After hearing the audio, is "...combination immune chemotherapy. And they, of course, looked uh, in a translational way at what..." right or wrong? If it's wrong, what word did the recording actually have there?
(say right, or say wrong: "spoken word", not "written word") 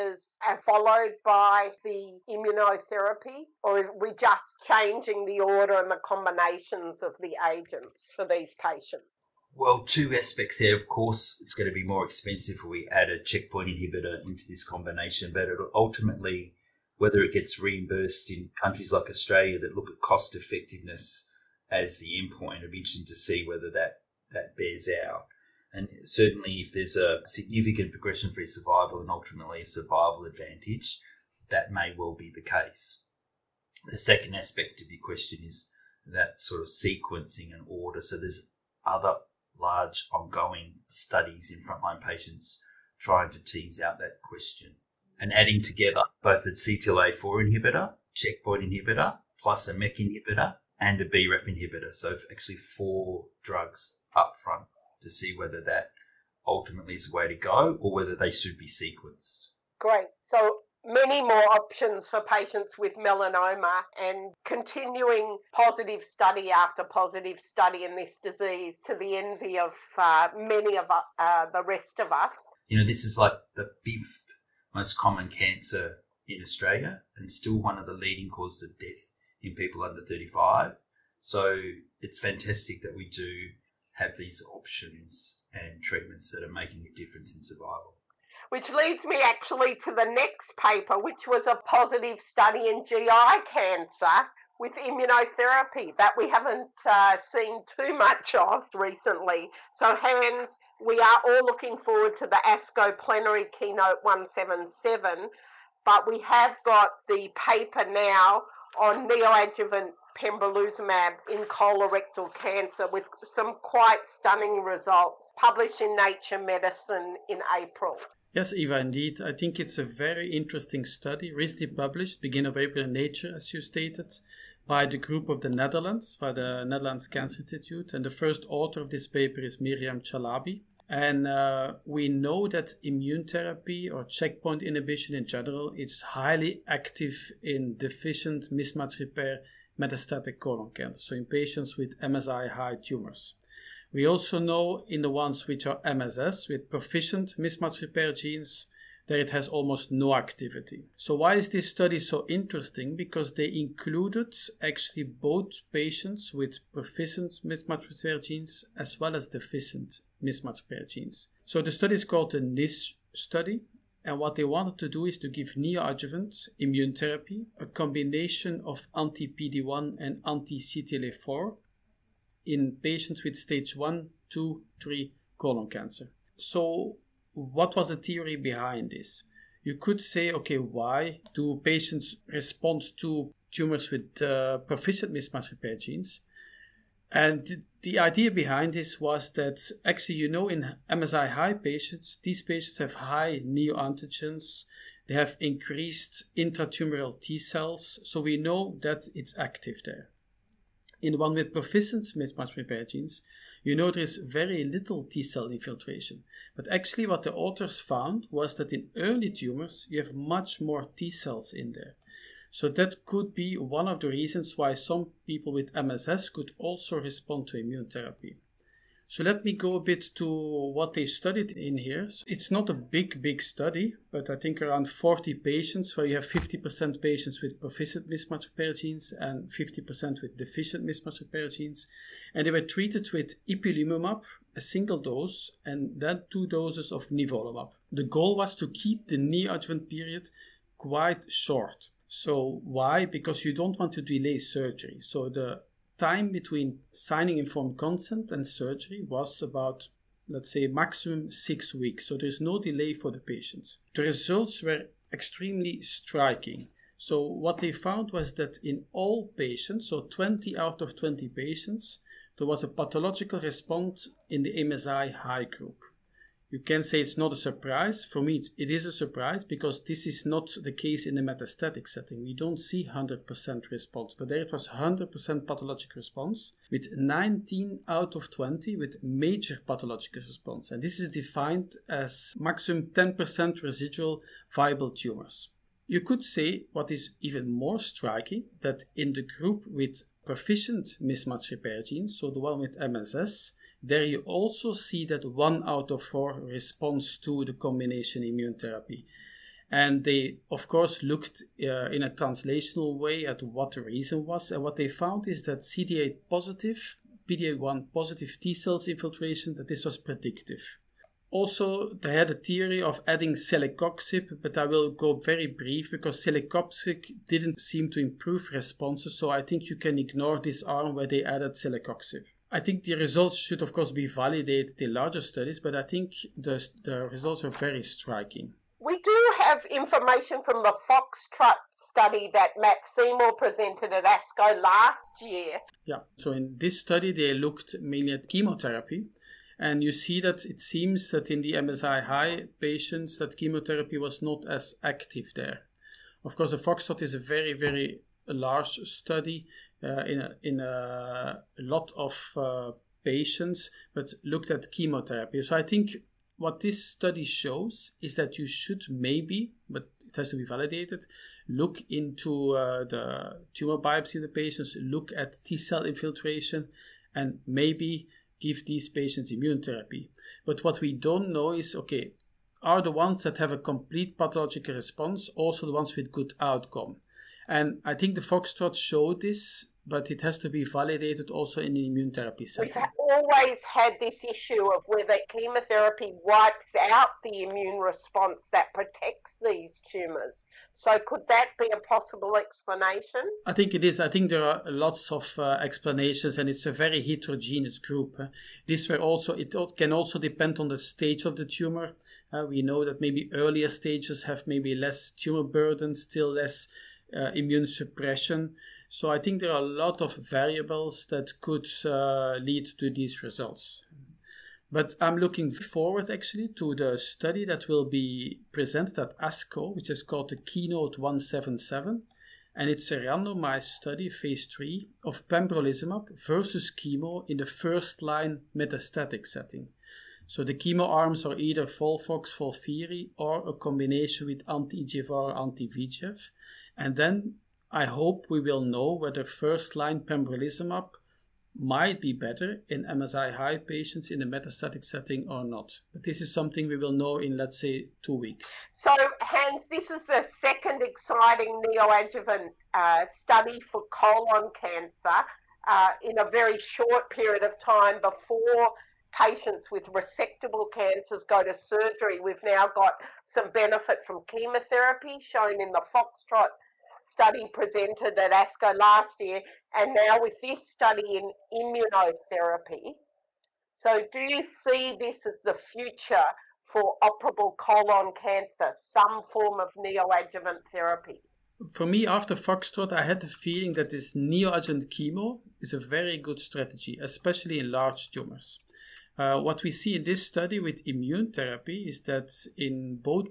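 wrong: "therapy", not "chemotherapy".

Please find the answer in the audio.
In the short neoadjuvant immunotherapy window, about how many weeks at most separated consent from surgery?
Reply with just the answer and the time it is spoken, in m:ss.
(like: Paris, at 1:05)
6, at 4:11.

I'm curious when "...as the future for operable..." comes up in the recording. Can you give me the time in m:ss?
7:55.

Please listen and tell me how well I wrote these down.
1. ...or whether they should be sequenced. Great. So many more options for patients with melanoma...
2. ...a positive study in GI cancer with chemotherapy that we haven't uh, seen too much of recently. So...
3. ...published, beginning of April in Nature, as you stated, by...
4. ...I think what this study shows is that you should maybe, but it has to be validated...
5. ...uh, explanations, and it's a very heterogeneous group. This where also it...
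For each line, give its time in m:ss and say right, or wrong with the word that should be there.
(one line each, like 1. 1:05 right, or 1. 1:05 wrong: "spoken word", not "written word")
1. 0:57 right
2. 1:31 wrong: "immunotherapy", not "chemotherapy"
3. 2:01 right
4. 5:55 right
5. 6:35 right.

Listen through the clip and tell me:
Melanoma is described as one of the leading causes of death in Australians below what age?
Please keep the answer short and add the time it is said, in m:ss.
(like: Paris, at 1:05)
35, at 1:20.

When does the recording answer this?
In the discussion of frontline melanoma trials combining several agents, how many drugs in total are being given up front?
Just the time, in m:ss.
0:52.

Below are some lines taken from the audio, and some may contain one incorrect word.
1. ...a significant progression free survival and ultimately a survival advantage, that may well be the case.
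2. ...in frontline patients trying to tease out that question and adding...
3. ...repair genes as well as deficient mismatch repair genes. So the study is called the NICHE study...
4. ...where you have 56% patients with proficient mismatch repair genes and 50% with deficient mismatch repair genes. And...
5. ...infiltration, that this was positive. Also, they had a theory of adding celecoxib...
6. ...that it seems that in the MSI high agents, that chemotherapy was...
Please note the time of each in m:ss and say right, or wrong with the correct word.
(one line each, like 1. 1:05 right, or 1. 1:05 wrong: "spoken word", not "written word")
1. 0:26 right
2. 0:41 right
3. 2:37 right
4. 3:45 wrong: "50", not "56"
5. 5:08 wrong: "predictive", not "positive"
6. 5:40 wrong: "patients", not "agents".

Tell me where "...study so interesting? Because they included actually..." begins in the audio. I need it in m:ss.
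2:31.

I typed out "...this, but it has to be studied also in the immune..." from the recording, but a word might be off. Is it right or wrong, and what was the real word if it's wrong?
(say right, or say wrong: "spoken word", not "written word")
wrong: "validated", not "studied".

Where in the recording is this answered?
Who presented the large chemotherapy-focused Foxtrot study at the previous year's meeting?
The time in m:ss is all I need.
5:32.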